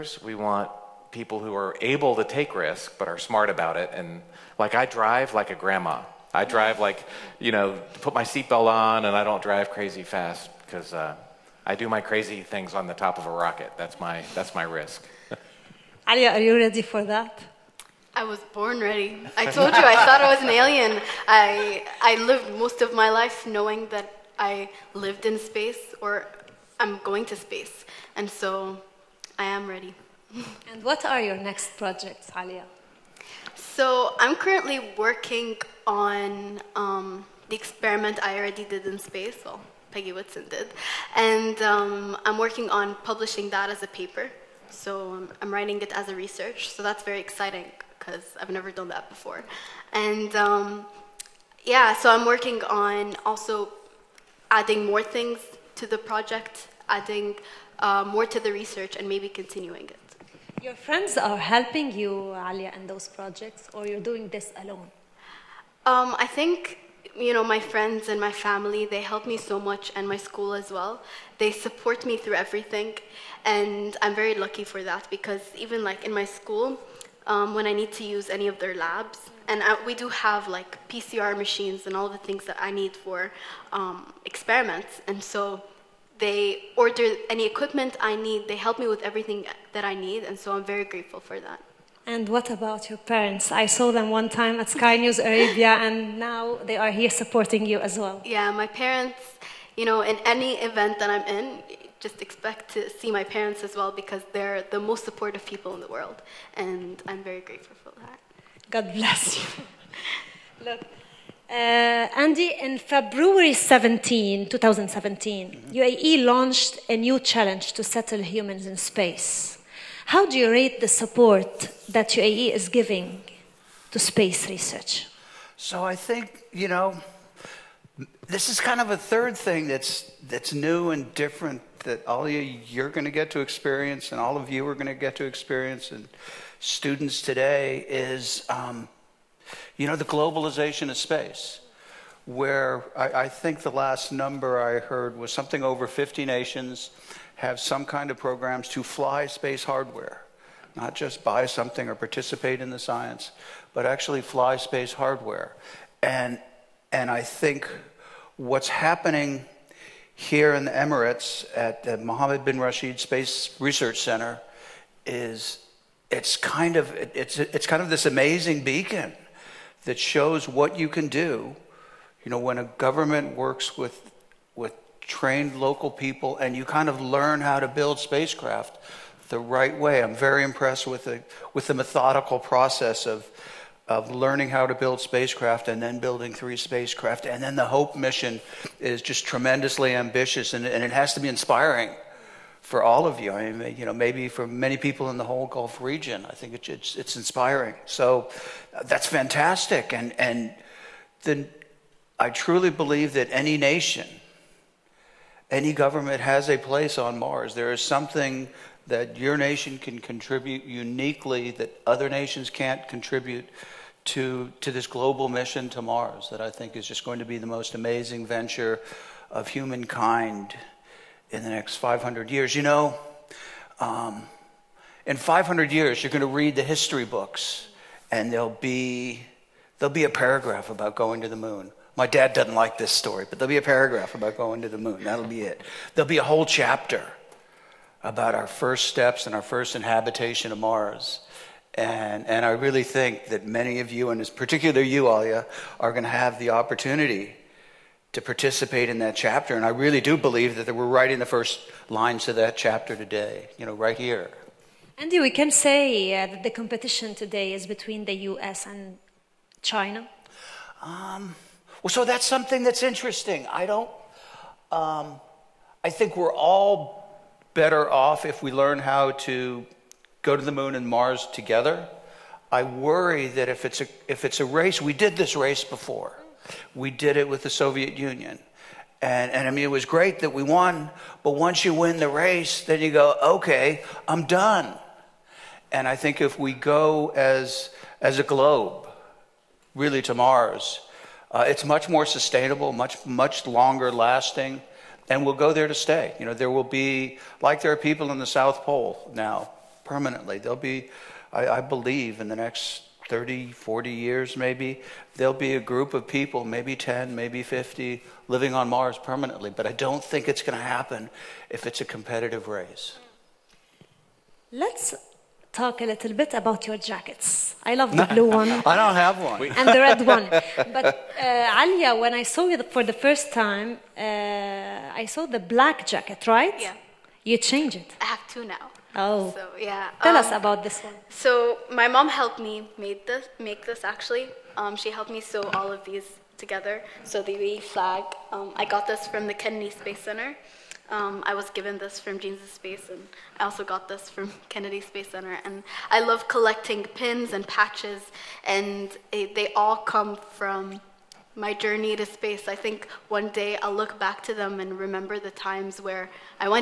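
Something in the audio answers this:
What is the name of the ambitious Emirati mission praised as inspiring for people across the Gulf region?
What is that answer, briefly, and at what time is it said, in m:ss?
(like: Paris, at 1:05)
HOPE mission, at 3:07.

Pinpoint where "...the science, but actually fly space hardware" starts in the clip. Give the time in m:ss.
2:32.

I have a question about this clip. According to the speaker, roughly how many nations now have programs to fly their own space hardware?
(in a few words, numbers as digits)
over 50.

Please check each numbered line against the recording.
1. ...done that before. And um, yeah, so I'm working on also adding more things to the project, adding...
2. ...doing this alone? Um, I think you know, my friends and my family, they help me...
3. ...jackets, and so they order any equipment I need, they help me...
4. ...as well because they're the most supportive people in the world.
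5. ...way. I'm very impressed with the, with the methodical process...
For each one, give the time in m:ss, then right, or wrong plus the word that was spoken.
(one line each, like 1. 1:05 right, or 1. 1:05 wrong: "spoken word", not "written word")
1. 0:48 right
2. 1:03 right
3. 1:24 wrong: "experiments", not "jackets"
4. 1:43 right
5. 2:59 right.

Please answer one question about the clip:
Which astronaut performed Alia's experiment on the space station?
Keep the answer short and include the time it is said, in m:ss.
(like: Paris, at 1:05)
Peggy Whitson, at 0:39.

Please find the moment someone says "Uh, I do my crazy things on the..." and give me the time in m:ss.
0:10.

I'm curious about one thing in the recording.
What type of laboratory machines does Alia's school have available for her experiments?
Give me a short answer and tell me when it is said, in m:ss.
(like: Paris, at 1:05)
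PCR machines, at 1:20.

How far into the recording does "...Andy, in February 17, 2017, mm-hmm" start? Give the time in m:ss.
1:52.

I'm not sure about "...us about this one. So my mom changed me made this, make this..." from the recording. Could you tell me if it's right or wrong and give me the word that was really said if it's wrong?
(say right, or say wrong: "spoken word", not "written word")
wrong: "helped", not "changed".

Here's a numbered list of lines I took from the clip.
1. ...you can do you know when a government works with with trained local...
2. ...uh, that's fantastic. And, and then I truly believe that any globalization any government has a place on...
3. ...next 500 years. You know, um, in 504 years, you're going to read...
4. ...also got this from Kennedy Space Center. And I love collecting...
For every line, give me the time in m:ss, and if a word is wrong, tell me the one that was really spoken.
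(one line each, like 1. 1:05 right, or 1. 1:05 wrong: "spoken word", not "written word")
1. 2:50 right
2. 3:18 wrong: "nation", not "globalization"
3. 3:41 wrong: "500", not "504"
4. 5:43 right.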